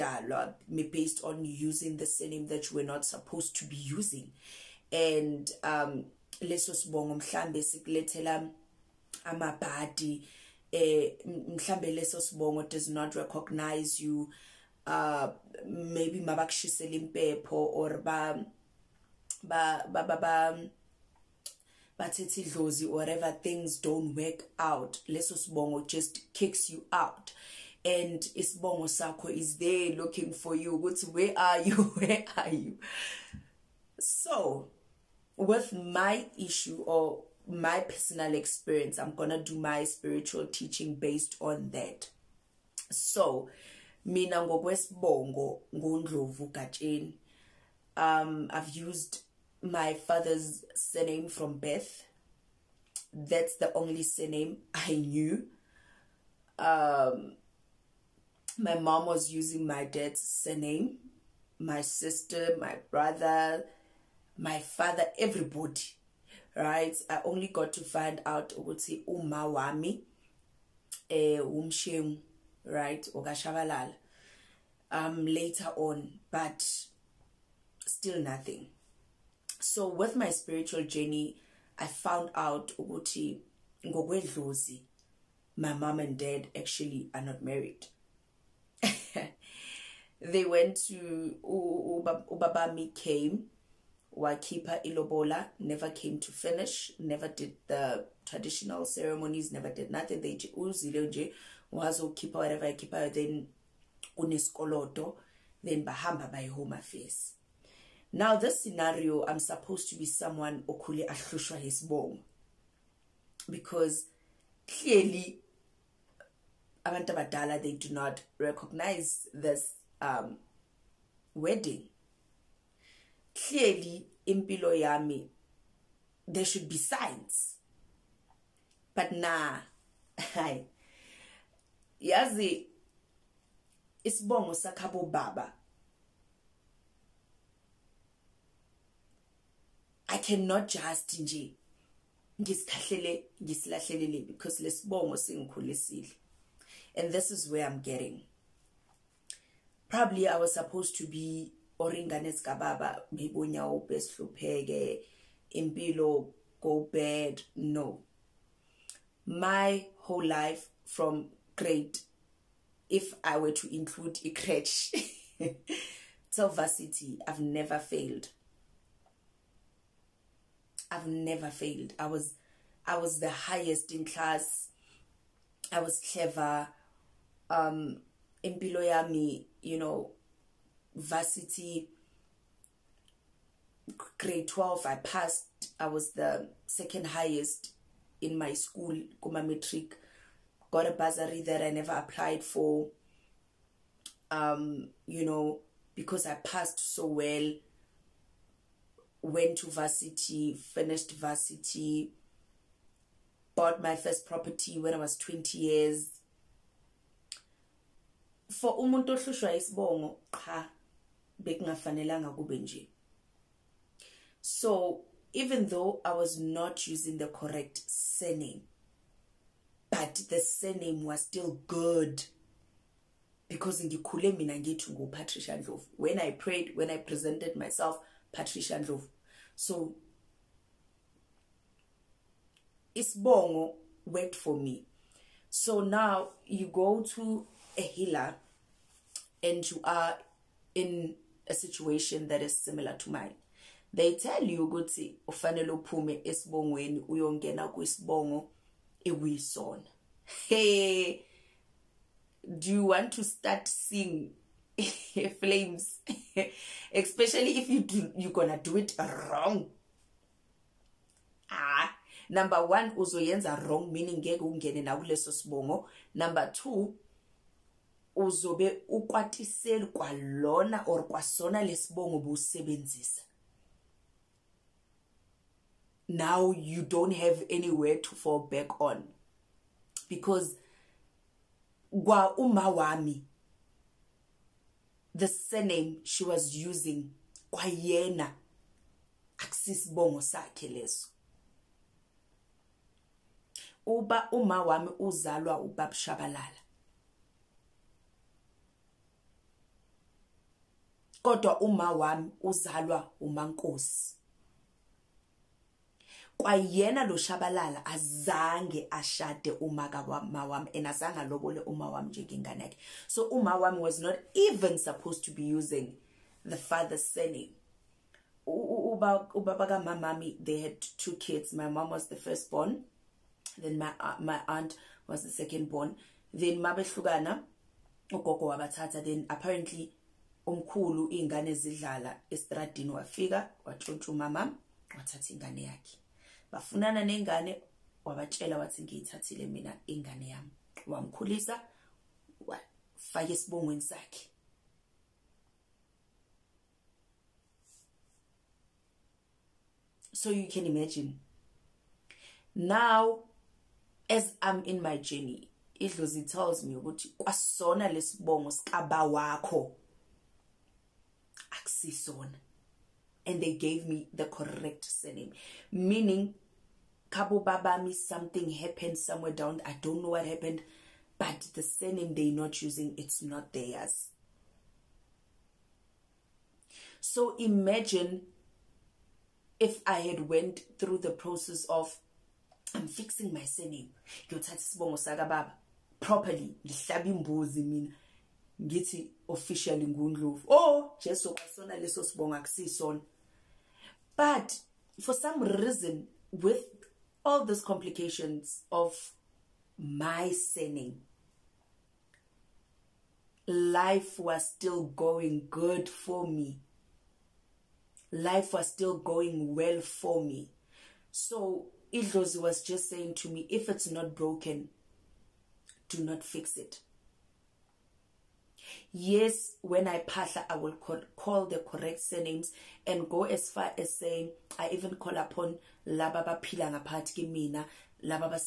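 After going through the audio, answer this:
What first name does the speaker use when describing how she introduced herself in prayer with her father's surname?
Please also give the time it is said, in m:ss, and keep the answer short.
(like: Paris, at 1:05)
Patricia, at 3:48.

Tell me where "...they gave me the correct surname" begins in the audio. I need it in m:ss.
6:03.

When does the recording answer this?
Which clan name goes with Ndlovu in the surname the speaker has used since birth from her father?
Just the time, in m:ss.
0:46.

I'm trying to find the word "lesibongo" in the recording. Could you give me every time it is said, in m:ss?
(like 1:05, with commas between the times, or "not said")
2:24, 4:31, 5:57.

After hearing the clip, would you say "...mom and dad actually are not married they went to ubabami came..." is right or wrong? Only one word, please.
right.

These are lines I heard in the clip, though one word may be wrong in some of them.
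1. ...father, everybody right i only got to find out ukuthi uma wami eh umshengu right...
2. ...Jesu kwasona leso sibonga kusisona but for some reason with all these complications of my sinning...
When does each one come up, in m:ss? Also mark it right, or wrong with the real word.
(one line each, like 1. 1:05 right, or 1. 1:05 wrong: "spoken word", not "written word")
1. 1:04 right
2. 6:31 right.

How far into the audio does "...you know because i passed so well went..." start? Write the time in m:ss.
3:15.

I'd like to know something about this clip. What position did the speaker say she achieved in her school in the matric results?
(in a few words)
Second highest.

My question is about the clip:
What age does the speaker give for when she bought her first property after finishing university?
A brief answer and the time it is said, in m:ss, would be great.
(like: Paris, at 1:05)
20, at 3:25.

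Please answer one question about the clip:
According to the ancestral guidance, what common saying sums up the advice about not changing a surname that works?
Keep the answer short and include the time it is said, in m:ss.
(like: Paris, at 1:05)
If it's not broken, do not fix it, at 6:53.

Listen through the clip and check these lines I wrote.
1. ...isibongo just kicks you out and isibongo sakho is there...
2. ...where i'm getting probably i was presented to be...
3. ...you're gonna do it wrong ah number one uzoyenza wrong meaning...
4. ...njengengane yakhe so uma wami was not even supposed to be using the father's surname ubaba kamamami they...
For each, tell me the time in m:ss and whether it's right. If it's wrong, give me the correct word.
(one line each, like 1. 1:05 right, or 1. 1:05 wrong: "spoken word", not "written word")
1. 0:25 wrong: "sibongo", not "isibongo"
2. 2:27 wrong: "supposed", not "presented"
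3. 4:18 right
4. 5:12 right.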